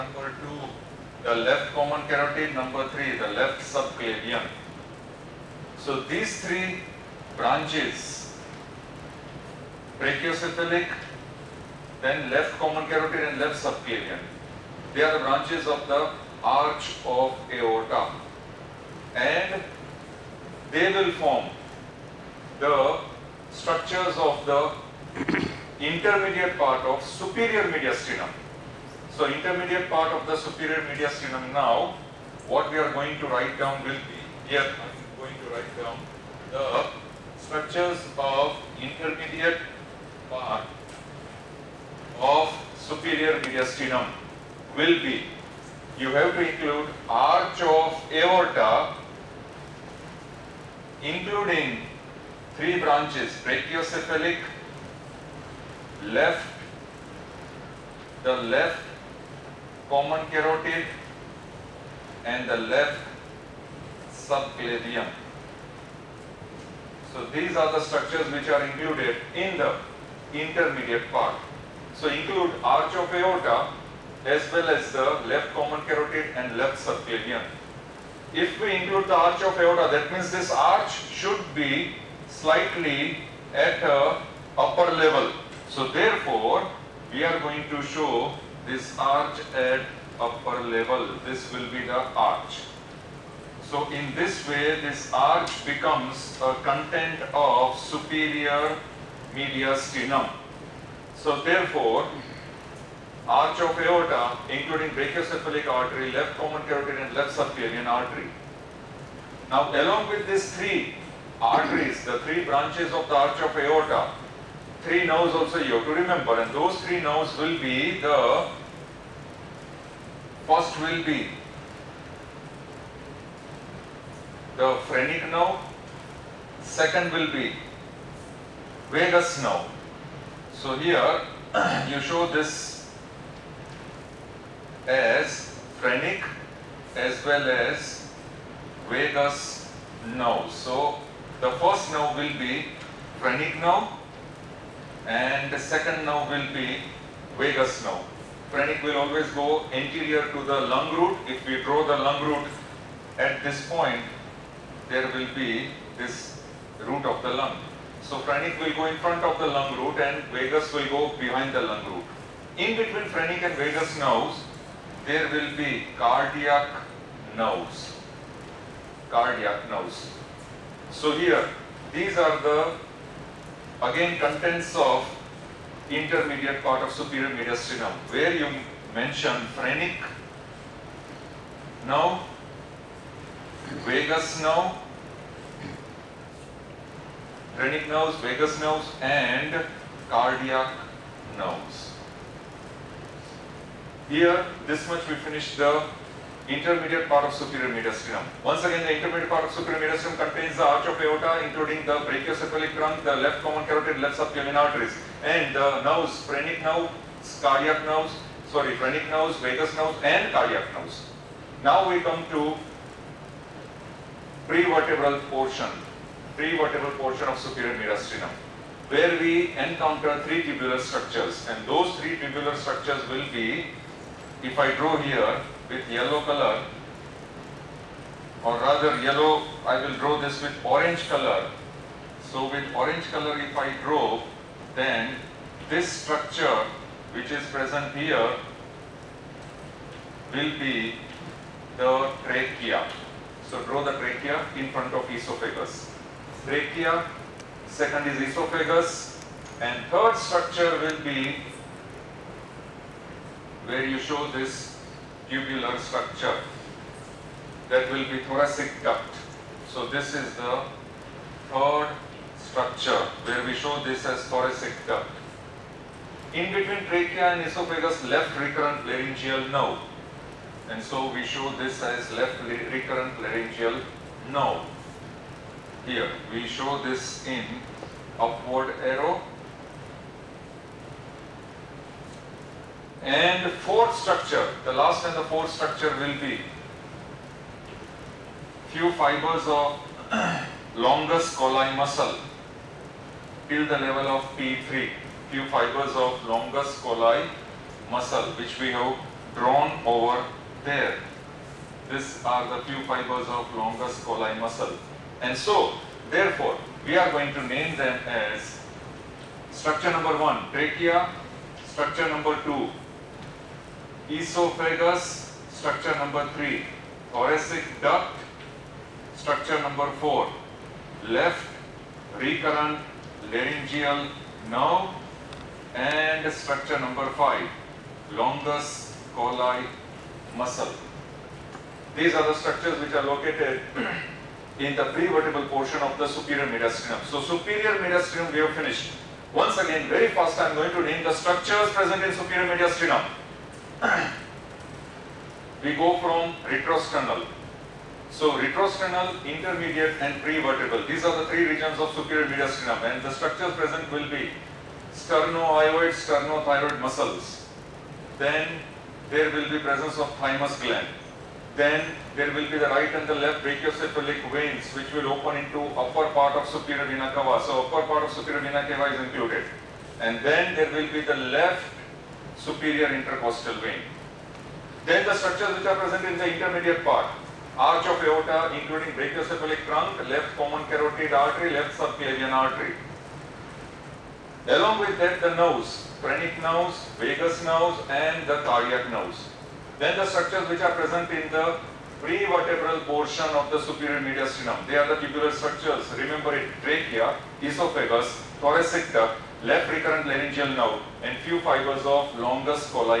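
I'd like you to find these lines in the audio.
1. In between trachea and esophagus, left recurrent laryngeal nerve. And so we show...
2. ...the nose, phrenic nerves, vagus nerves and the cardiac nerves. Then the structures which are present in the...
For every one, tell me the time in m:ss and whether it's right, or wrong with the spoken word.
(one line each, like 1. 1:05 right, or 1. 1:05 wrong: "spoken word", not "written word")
1. 4:26 right
2. 6:25 right.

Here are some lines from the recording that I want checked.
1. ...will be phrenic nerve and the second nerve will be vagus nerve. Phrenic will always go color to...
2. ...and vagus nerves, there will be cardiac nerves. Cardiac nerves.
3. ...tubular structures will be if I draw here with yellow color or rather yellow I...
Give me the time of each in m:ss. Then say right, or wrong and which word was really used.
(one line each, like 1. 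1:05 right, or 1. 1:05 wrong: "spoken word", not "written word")
1. 2:22 wrong: "anterior", not "color"
2. 2:43 right
3. 3:42 right.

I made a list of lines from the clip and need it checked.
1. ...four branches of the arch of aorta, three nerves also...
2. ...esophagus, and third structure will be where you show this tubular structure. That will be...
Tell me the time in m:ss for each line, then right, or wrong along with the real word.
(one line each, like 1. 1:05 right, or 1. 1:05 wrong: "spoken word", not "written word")
1. 1:52 wrong: "three", not "four"
2. 4:08 right.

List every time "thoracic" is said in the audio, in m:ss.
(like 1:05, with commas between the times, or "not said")
4:18, 4:24, 5:17, 6:38.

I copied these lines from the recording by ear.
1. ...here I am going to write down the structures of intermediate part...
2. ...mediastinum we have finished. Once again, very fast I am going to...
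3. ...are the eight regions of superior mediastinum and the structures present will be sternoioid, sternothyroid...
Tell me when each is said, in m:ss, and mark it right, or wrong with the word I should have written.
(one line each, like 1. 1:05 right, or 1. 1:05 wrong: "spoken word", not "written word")
1. 0:34 right
2. 5:37 right
3. 5:51 wrong: "three", not "eight".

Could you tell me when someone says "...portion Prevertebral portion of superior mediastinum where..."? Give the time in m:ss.
3:35.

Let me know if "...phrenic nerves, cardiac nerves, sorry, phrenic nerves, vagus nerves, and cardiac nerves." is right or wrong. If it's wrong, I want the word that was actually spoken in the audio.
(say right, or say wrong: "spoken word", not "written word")
right.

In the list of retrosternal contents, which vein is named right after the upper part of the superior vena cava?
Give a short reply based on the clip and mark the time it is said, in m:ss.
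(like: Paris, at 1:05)
Left superior intercostal vein, at 6:11.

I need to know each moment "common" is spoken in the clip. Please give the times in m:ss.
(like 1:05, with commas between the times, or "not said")
0:01, 0:12, 0:59, 1:15, 1:46, 3:23, 6:20.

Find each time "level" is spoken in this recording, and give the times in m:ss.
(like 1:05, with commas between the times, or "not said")
1:24, 1:30, 4:53.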